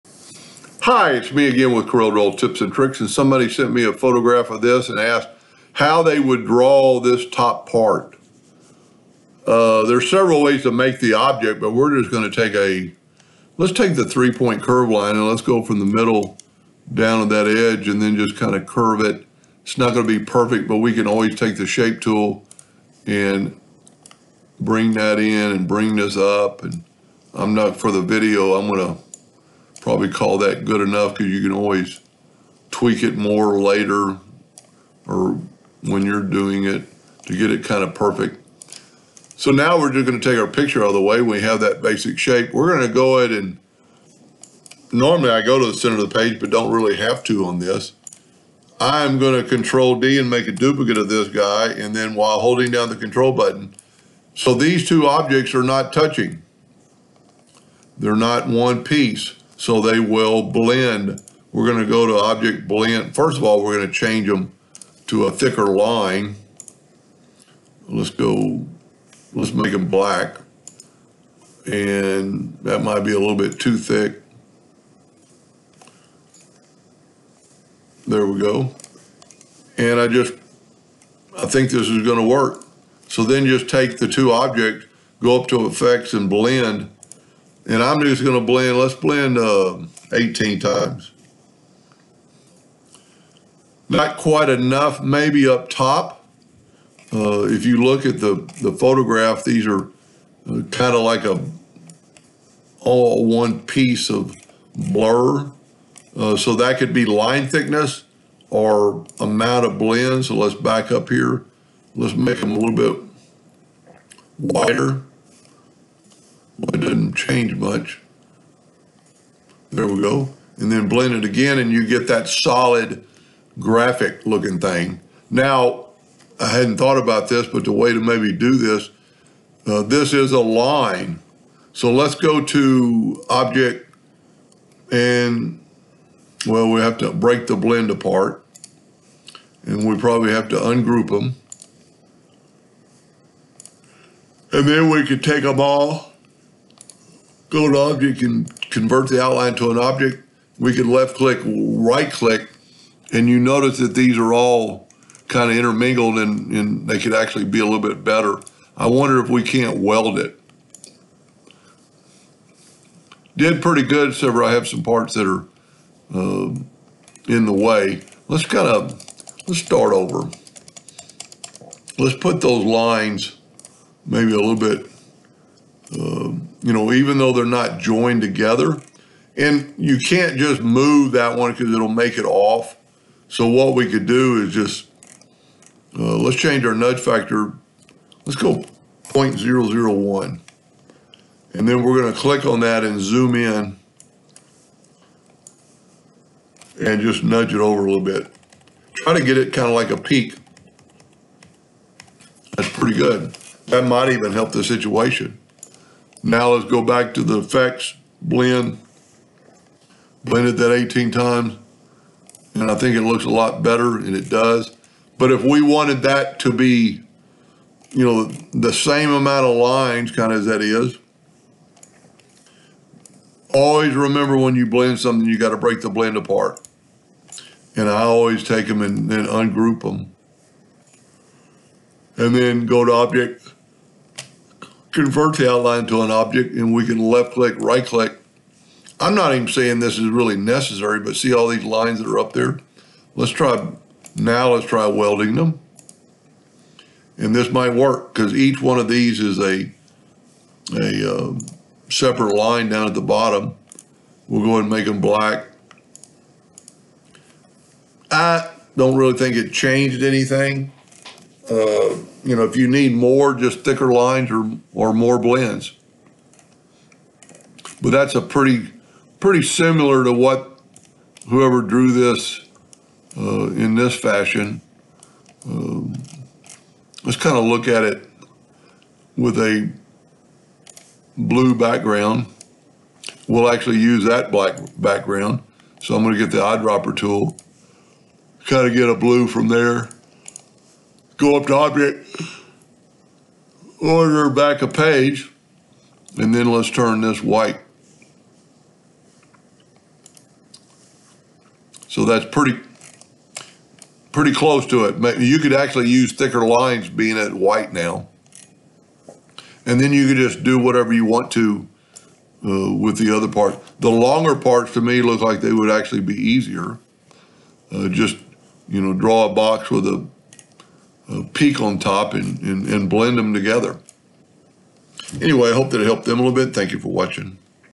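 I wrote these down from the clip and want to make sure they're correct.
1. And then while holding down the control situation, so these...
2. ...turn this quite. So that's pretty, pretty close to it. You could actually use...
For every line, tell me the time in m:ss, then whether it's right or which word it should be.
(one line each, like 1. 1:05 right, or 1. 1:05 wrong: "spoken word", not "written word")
1. 0:51 wrong: "button", not "situation"
2. 4:56 wrong: "white", not "quite".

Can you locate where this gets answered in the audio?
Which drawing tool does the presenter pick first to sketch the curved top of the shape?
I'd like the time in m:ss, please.
0:14.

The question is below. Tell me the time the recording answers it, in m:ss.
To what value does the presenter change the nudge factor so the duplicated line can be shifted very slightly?
3:09.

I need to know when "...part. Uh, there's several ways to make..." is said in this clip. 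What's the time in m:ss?
0:07.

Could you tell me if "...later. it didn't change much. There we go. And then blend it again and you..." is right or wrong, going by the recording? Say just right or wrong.
wrong.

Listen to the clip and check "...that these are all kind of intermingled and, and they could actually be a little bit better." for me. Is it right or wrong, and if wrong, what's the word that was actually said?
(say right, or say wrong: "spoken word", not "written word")
right.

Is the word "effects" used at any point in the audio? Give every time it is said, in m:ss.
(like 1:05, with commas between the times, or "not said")
1:25, 3:27.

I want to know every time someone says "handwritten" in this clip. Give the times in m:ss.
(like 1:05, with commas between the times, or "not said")
not said.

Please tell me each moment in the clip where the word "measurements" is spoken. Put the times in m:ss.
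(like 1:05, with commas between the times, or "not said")
not said.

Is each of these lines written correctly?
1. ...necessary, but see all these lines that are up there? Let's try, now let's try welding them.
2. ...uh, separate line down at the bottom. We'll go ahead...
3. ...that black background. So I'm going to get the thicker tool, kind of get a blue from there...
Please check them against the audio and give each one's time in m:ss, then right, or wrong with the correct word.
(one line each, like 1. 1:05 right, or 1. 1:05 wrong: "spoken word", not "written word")
1. 4:00 right
2. 4:11 right
3. 4:44 wrong: "eyedropper", not "thicker".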